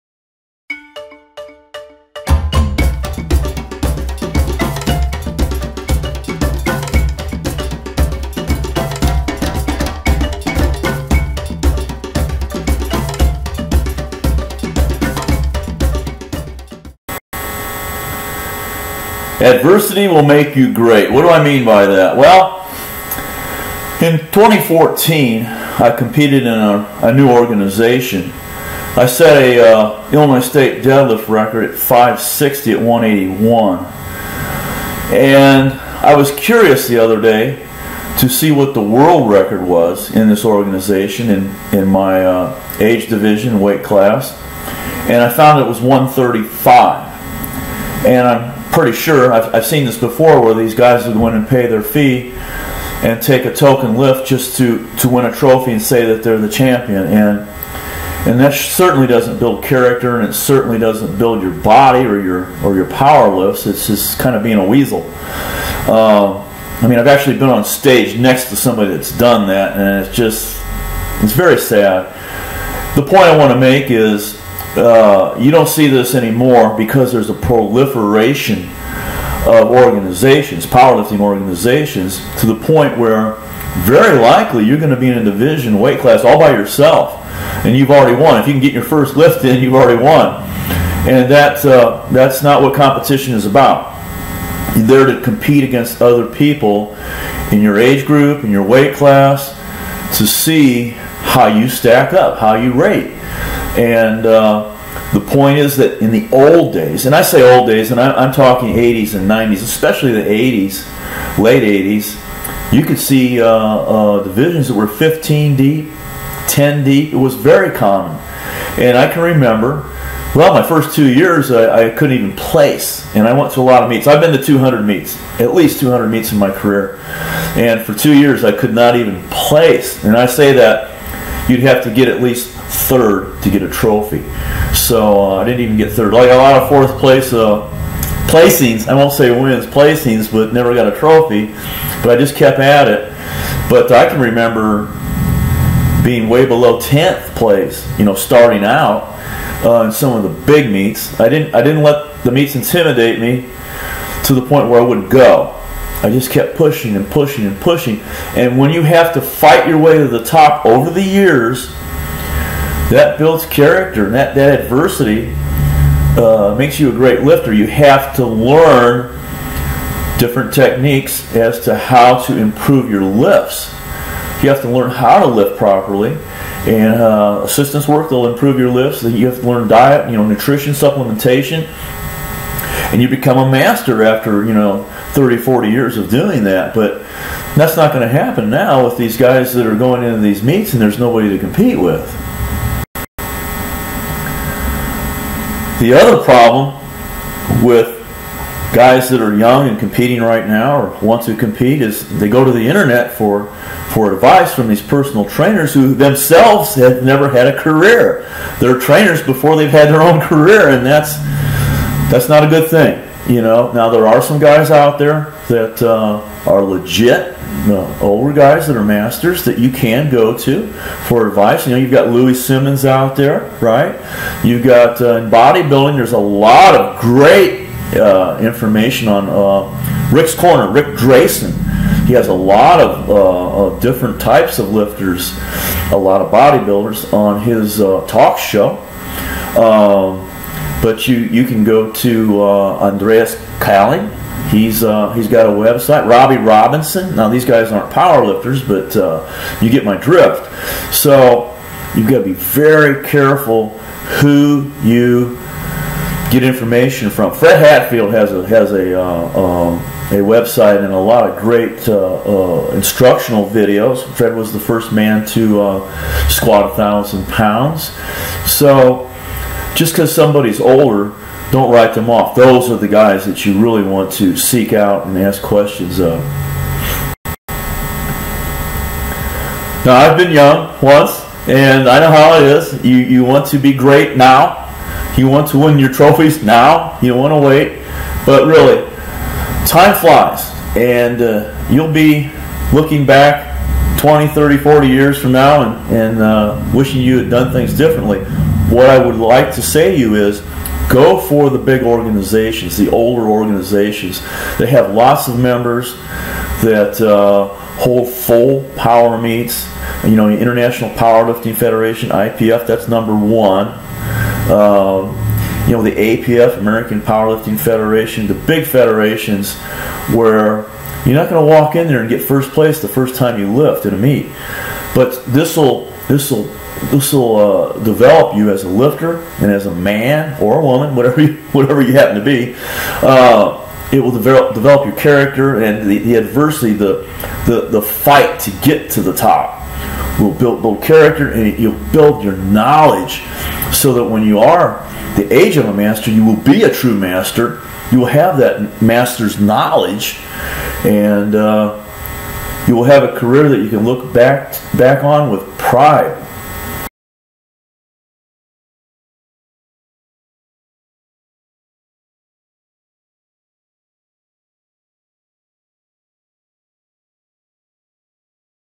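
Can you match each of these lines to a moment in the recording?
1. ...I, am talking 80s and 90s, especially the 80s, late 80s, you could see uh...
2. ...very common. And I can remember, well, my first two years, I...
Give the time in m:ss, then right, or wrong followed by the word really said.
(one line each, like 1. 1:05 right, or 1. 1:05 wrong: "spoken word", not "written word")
1. 1:48 right
2. 1:57 right.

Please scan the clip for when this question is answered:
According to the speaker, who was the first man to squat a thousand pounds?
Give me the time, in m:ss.
4:17.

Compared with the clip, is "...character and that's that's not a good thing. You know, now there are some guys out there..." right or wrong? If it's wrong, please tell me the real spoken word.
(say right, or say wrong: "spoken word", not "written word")
wrong: "career", not "character".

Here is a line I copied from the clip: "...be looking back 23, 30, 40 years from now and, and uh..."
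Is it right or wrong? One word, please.
wrong.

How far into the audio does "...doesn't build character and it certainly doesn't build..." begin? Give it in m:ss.
0:59.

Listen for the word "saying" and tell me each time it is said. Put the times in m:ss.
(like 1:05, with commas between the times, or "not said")
not said.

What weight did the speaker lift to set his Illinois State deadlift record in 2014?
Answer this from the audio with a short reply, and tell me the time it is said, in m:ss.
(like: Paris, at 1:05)
560, at 0:31.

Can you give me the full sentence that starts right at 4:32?
Those are the guys that you really want to seek out and ask questions of.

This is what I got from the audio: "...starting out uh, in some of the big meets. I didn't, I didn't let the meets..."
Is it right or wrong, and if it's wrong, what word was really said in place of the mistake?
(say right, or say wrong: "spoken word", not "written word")
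right.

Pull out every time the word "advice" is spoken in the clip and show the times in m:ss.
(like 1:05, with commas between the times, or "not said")
3:24, 3:41.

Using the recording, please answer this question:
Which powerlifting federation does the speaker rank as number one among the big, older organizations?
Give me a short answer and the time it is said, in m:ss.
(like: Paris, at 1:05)
International Powerlifting Federation, at 5:10.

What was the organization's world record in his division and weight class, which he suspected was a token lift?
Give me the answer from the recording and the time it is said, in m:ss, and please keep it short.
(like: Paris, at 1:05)
135, at 0:45.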